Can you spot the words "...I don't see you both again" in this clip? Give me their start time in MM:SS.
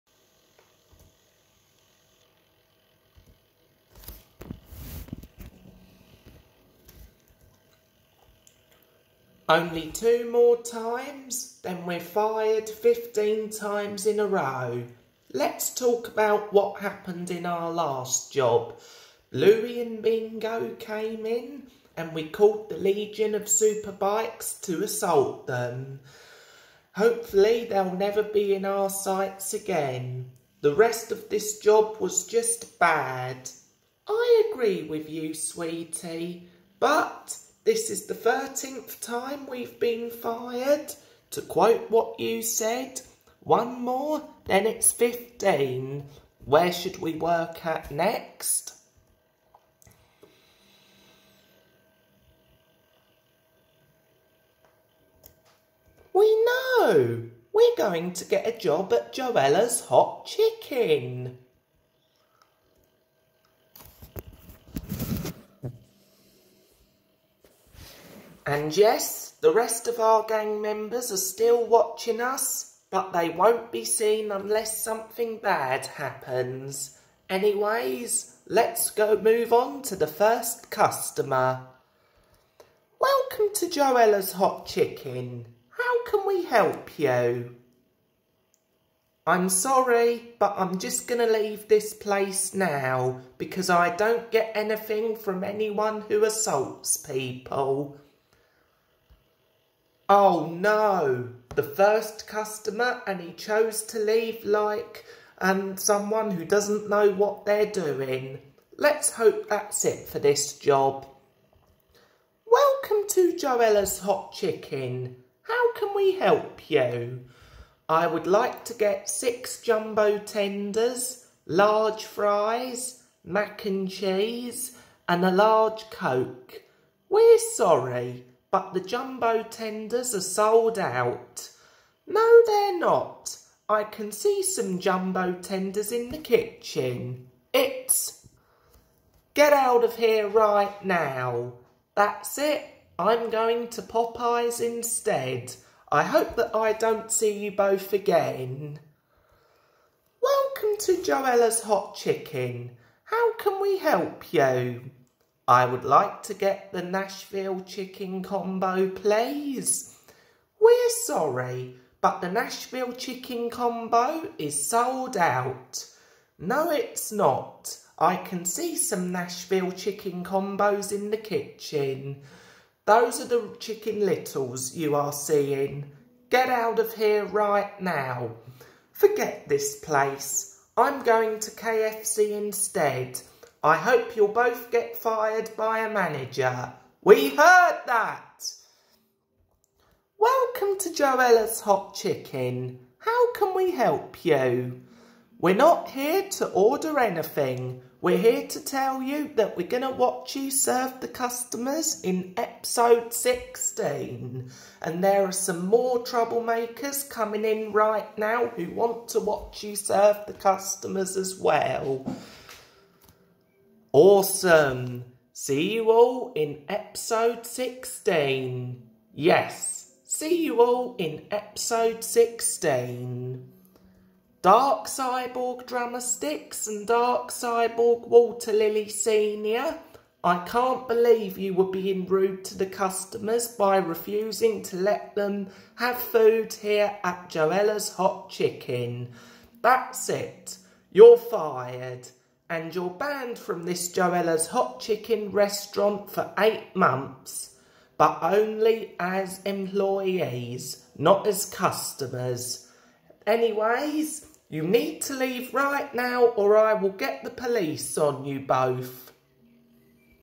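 02:26.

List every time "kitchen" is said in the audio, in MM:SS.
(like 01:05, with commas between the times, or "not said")
02:16, 02:51.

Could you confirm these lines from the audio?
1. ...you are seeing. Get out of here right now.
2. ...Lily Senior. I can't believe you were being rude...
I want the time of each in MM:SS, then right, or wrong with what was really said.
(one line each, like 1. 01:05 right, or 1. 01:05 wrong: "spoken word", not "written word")
1. 02:54 right
2. 03:48 right.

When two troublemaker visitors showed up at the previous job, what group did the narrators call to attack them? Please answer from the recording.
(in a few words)
Legion of superbikes.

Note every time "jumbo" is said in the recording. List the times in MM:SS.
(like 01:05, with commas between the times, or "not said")
01:59, 02:08, 02:14.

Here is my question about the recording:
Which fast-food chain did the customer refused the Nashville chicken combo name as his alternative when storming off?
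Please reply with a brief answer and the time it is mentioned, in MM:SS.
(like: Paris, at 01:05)
KFC, at 03:01.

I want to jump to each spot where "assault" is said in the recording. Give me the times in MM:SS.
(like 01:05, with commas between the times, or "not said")
00:24, 01:36.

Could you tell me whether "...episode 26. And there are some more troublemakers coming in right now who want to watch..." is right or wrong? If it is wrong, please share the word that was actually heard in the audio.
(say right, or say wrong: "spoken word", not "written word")
wrong: "16", not "26".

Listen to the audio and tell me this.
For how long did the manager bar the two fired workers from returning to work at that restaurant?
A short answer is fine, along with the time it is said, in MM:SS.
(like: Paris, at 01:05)
8 months, at 04:06.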